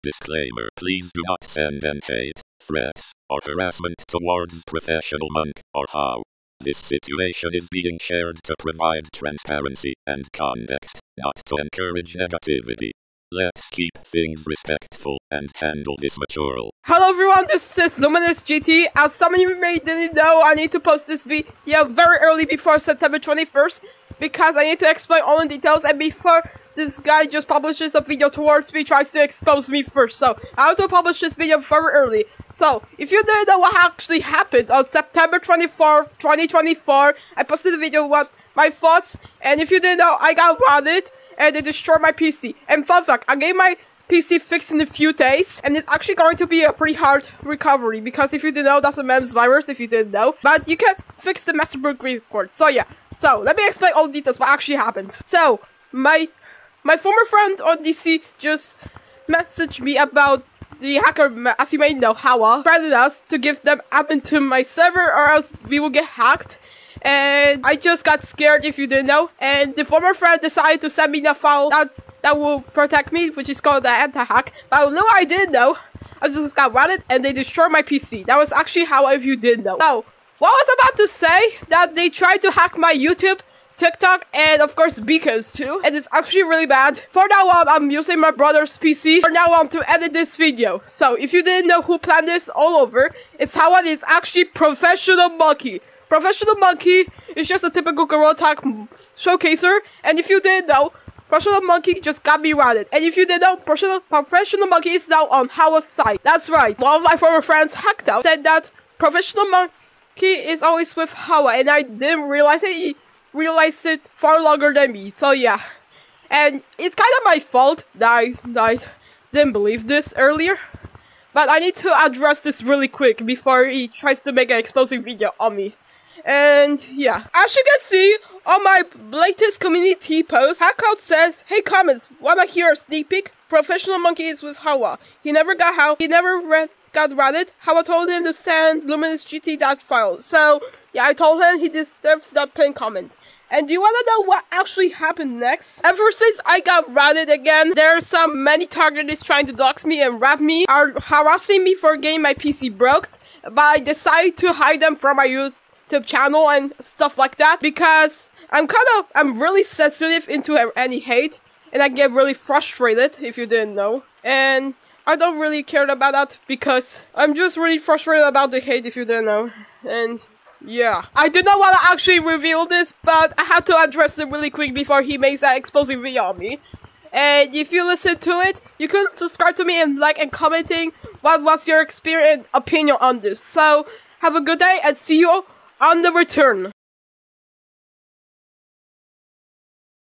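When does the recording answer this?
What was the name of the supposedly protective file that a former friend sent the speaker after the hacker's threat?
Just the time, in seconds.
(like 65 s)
73 s.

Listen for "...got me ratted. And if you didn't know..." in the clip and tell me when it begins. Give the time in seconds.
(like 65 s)
102 s.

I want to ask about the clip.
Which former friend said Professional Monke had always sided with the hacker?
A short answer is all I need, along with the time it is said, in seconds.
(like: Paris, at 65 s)
Hackdown, at 107 s.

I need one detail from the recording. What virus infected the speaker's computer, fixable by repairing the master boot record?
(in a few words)
MEMS virus.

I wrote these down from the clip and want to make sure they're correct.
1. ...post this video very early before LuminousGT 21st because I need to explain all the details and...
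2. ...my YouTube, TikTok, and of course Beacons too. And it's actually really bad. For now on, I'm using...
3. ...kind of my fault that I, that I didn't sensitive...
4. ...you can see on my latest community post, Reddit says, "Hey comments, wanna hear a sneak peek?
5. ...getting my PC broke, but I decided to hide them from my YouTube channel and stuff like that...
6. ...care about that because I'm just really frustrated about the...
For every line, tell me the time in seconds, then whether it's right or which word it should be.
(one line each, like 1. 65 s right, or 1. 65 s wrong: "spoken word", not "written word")
1. 20 s wrong: "September", not "LuminousGT"
2. 82 s right
3. 117 s wrong: "believe", not "sensitive"
4. 127 s wrong: "Hackout", not "Reddit"
5. 151 s right
6. 165 s right.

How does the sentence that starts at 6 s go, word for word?
This situation is being shared to provide transparency and context, not to encourage negativity.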